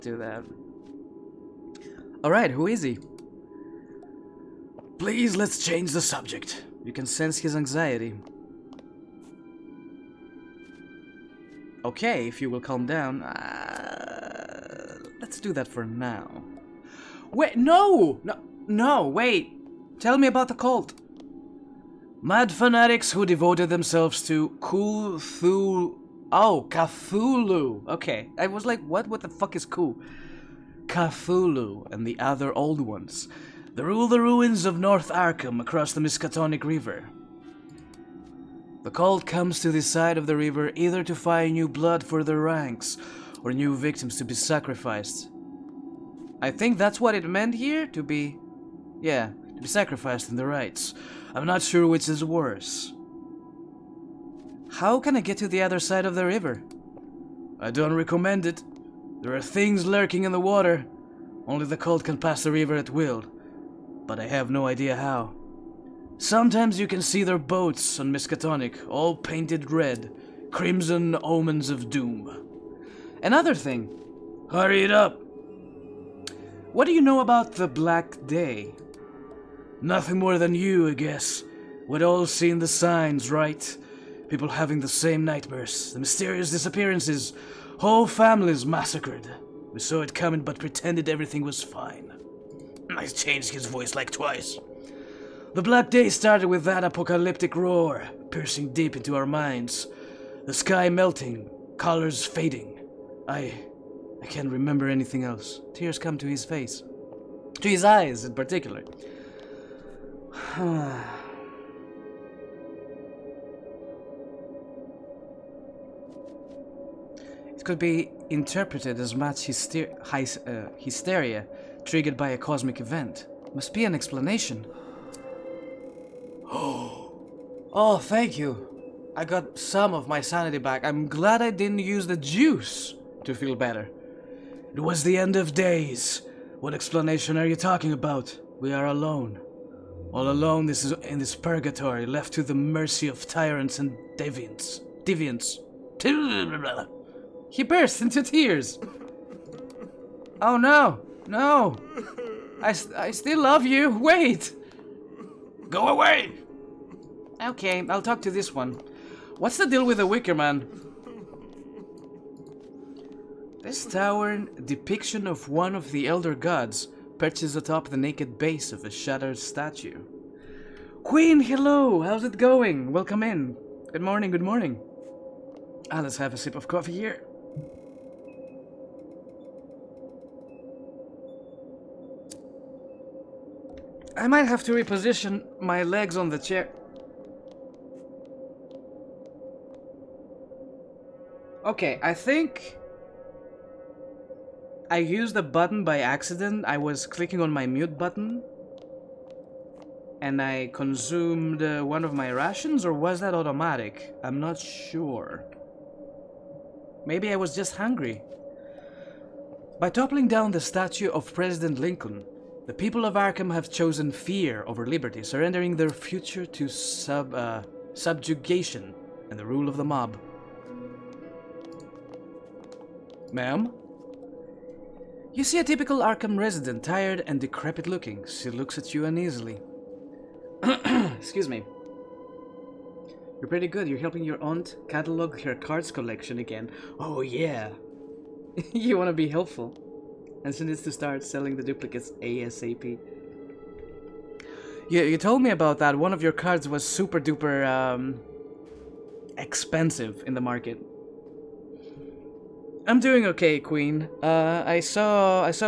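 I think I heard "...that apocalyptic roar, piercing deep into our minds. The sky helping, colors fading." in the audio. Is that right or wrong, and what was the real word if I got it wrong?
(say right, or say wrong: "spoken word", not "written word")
wrong: "melting", not "helping".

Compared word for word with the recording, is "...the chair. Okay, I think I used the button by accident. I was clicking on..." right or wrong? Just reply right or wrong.
right.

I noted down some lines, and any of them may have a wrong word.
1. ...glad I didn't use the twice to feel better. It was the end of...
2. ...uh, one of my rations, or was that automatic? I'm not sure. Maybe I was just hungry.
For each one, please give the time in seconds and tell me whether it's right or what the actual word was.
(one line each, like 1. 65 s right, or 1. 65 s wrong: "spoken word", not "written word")
1. 131 s wrong: "juice", not "twice"
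2. 201 s right.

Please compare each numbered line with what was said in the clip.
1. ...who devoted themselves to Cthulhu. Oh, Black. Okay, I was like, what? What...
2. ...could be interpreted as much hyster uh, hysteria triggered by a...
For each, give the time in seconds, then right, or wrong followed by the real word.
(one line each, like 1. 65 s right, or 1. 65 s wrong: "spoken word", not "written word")
1. 23 s wrong: "Cthulhu", not "Black"
2. 117 s right.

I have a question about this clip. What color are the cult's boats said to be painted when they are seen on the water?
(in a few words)
Red.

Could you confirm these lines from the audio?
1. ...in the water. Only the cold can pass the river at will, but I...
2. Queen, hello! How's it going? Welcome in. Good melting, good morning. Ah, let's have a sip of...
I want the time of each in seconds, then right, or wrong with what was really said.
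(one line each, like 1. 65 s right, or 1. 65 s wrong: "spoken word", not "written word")
1. 60 s right
2. 171 s wrong: "morning", not "melting".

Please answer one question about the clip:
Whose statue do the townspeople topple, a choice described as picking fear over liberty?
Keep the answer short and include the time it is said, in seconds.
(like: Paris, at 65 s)
President Lincoln, at 211 s.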